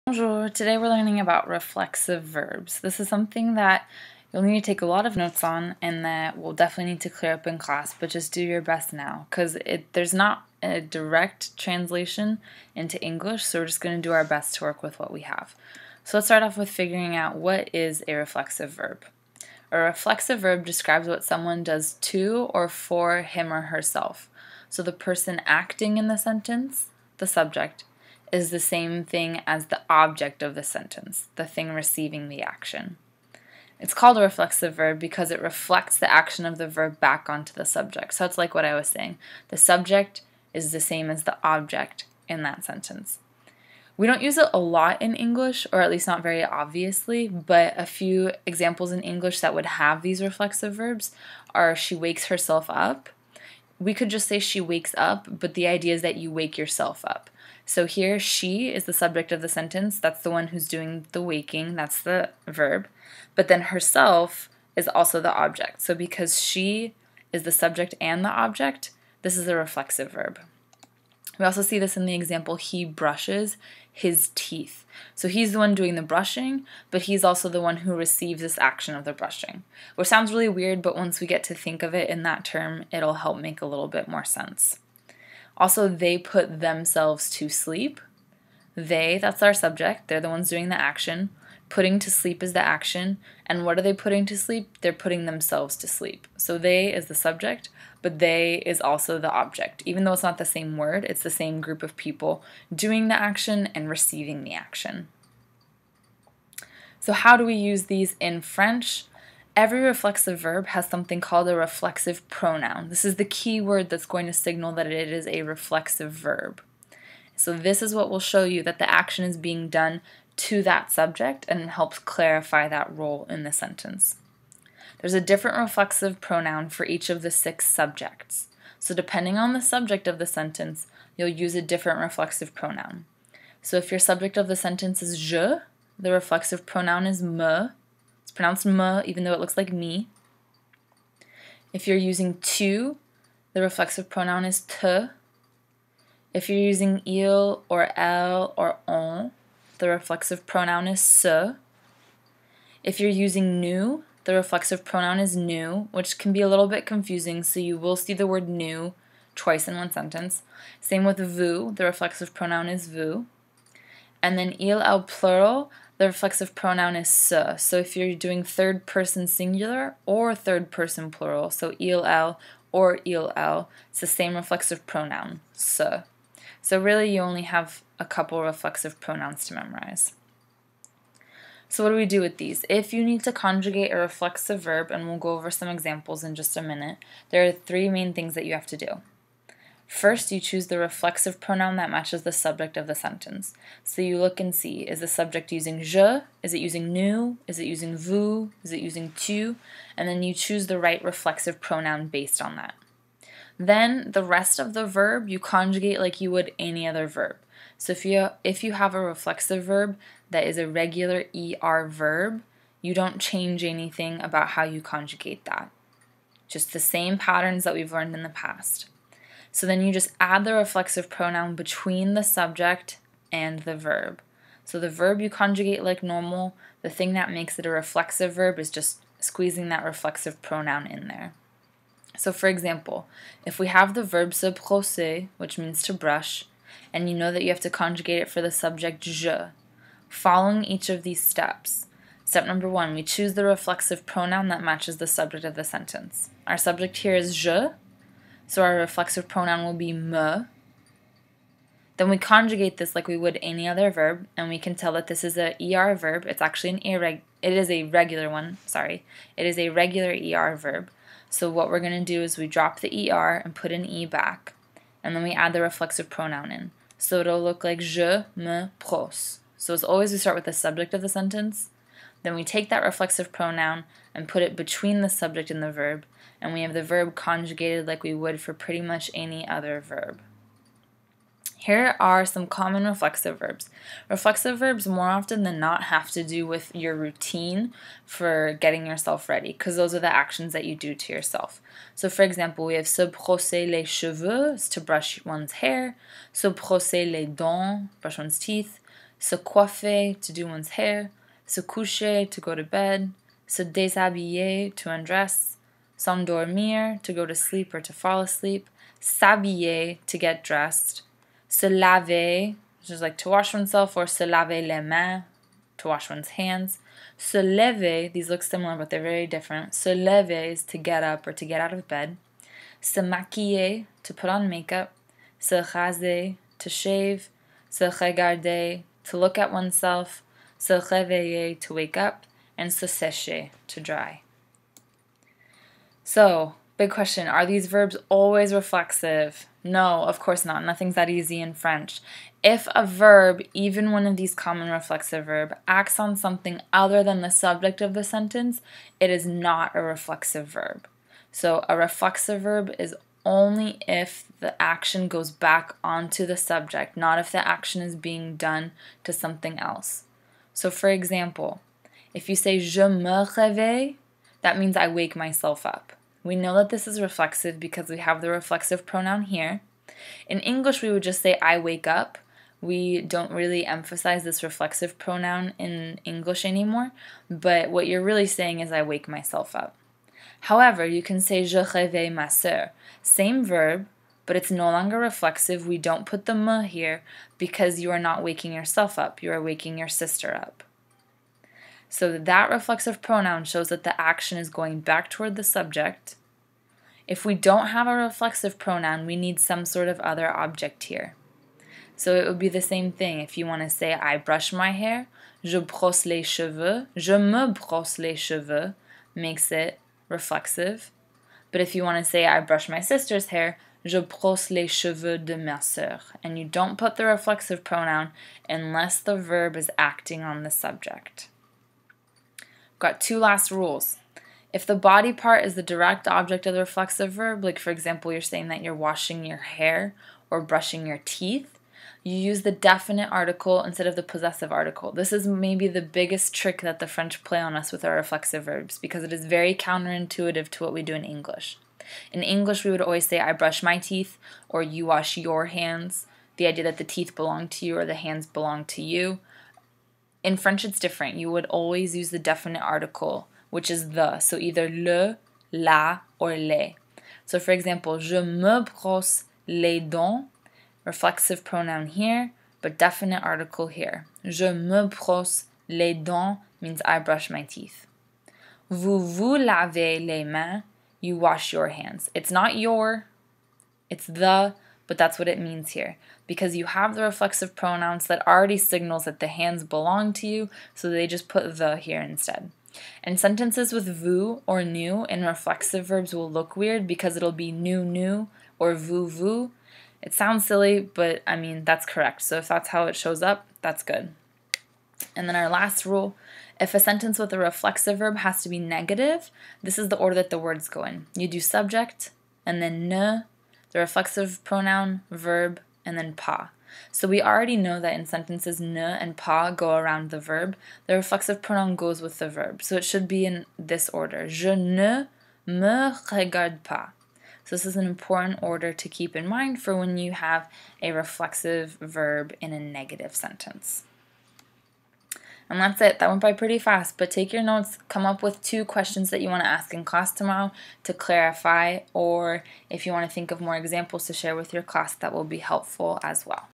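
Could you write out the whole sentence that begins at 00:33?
It's called a reflexive verb because it reflects the action of the verb back onto the subject.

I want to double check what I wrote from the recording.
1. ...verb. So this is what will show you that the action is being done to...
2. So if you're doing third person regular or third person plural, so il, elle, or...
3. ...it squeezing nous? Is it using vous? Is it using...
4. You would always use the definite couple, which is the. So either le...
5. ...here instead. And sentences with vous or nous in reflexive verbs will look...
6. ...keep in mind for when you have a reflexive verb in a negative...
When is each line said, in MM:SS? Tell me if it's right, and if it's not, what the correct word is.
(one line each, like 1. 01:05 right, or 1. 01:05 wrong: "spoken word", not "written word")
1. 01:56 right
2. 02:47 wrong: "singular", not "regular"
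3. 03:16 wrong: "using", not "squeezing"
4. 07:31 wrong: "article", not "couple"
5. 08:01 right
6. 08:38 right.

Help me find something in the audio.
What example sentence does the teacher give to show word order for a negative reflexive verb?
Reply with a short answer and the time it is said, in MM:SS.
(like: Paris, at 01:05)
Je ne me regarde pas, at 08:34.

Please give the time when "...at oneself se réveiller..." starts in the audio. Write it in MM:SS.
05:29.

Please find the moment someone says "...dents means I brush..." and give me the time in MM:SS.
07:45.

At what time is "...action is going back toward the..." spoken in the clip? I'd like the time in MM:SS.
06:33.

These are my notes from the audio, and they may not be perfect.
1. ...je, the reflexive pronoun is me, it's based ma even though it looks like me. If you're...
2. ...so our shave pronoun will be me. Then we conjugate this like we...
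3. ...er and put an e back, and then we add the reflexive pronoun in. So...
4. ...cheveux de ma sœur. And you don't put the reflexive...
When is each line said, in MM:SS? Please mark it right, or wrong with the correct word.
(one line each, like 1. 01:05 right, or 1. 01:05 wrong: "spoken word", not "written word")
1. 02:15 wrong: "pronounced", not "based"
2. 04:08 wrong: "reflexive", not "shave"
3. 04:23 right
4. 06:54 right.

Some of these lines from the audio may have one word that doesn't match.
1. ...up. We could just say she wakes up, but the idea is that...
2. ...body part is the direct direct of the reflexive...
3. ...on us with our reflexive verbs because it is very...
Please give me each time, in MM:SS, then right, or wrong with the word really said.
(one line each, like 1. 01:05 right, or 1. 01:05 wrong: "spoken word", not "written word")
1. 00:52 right
2. 07:04 wrong: "object", not "direct"
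3. 07:17 right.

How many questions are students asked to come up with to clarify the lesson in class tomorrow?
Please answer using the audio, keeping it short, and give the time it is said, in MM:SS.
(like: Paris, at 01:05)
2, at 08:48.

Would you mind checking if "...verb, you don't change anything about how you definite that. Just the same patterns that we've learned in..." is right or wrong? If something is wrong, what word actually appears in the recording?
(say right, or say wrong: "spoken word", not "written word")
wrong: "conjugate", not "definite".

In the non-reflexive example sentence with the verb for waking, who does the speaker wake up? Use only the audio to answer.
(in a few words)
ma soeur.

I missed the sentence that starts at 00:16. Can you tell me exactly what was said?
So let's start off with figuring out what is a reflexive verb.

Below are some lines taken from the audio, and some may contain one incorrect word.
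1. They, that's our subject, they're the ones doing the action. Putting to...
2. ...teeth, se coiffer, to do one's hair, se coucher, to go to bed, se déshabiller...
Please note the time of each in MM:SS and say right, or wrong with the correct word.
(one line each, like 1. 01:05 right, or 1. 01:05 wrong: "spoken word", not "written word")
1. 01:28 right
2. 04:58 right.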